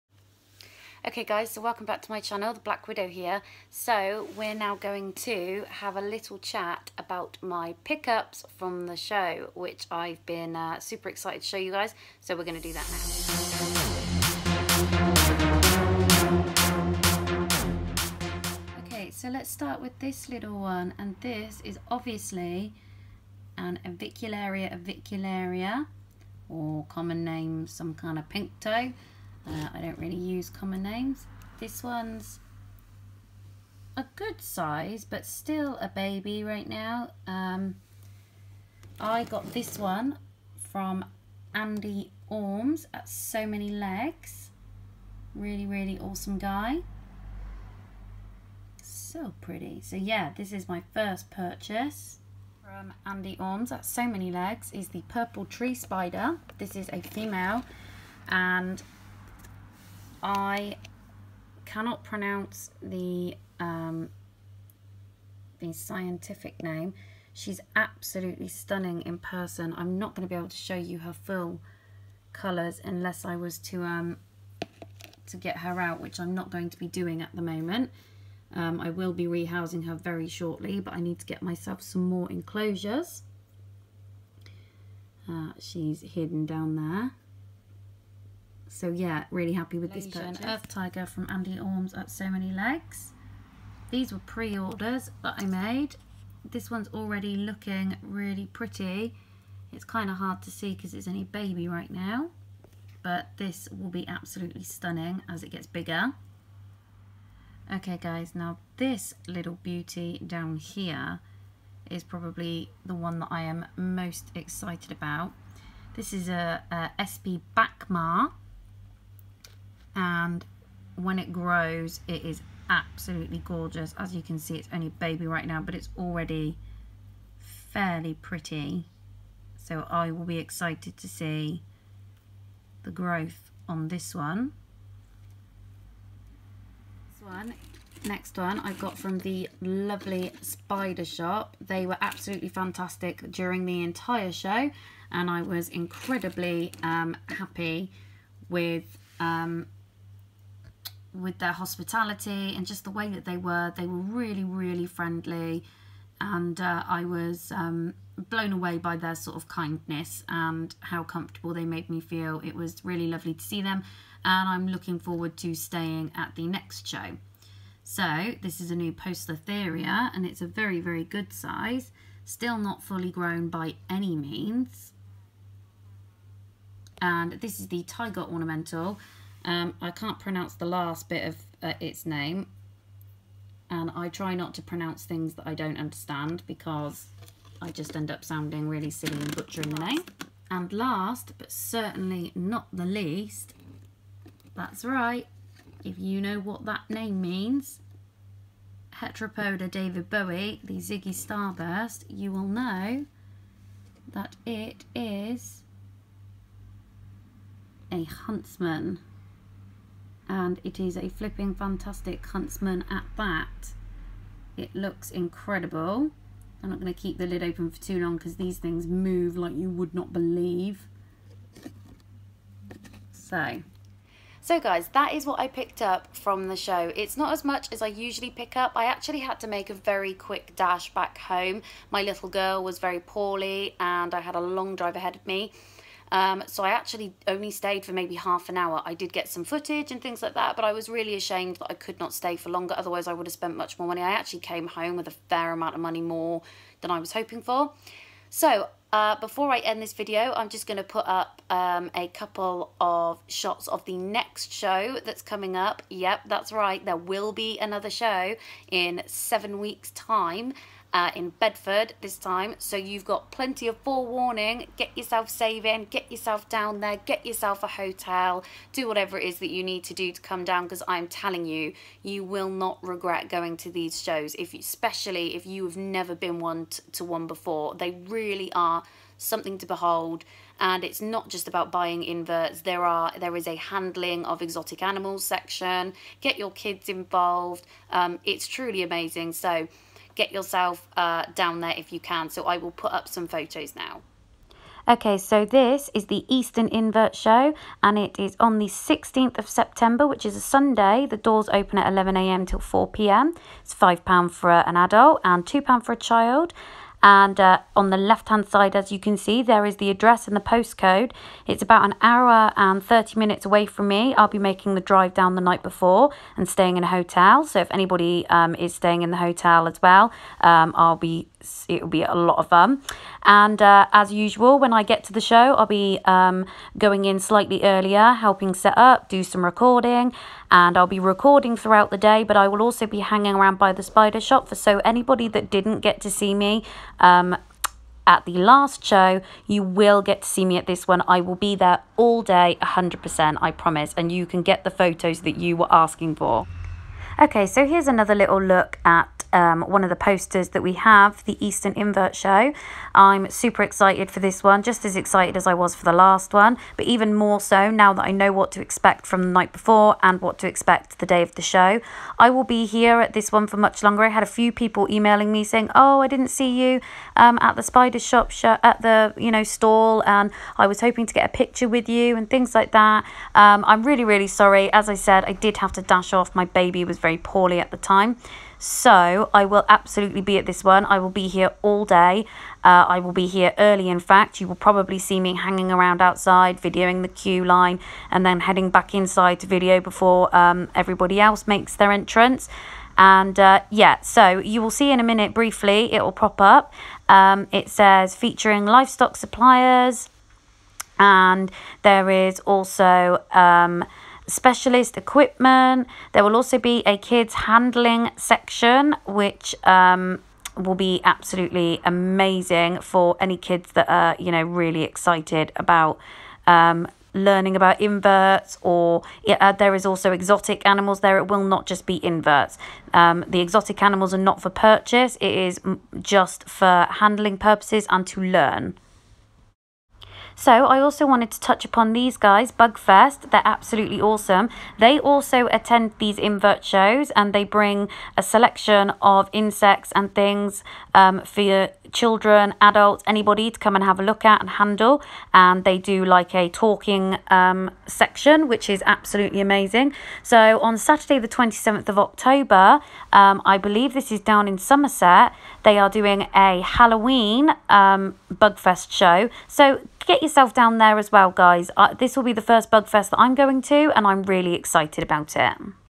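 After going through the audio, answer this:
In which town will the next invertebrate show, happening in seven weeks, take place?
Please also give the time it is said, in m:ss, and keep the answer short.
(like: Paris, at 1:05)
Bedford, at 4:21.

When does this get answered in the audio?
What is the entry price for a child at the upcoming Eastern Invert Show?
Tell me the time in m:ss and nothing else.
5:05.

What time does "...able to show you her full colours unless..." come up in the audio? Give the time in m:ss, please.
1:10.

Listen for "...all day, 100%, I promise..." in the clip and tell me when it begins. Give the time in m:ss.
5:41.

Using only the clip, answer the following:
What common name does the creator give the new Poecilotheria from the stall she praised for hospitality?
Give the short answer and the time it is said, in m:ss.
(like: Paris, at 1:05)
Tiger Ornamental, at 2:57.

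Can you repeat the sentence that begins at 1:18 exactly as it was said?
Um, I will be rehousing her very shortly, but I need to get myself some more enclosures.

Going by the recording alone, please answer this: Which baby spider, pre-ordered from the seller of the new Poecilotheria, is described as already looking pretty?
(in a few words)
Earth Tiger.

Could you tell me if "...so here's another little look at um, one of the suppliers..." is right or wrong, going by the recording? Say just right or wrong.
wrong.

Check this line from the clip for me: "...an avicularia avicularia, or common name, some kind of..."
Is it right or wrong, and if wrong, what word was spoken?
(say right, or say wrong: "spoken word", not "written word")
right.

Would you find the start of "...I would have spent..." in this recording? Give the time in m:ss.
4:03.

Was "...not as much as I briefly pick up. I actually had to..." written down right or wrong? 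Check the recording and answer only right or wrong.
wrong.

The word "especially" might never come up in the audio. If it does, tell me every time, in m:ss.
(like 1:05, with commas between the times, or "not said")
4:34.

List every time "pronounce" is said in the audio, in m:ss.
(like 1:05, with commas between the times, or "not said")
1:02, 3:00, 3:04.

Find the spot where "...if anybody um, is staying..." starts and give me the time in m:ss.
5:17.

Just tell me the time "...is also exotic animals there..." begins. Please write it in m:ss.
6:59.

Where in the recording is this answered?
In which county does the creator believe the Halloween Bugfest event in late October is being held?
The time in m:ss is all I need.
7:34.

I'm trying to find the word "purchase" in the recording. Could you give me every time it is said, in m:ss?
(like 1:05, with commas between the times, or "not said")
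0:51, 1:30, 7:04.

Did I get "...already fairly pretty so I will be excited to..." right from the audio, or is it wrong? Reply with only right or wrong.
right.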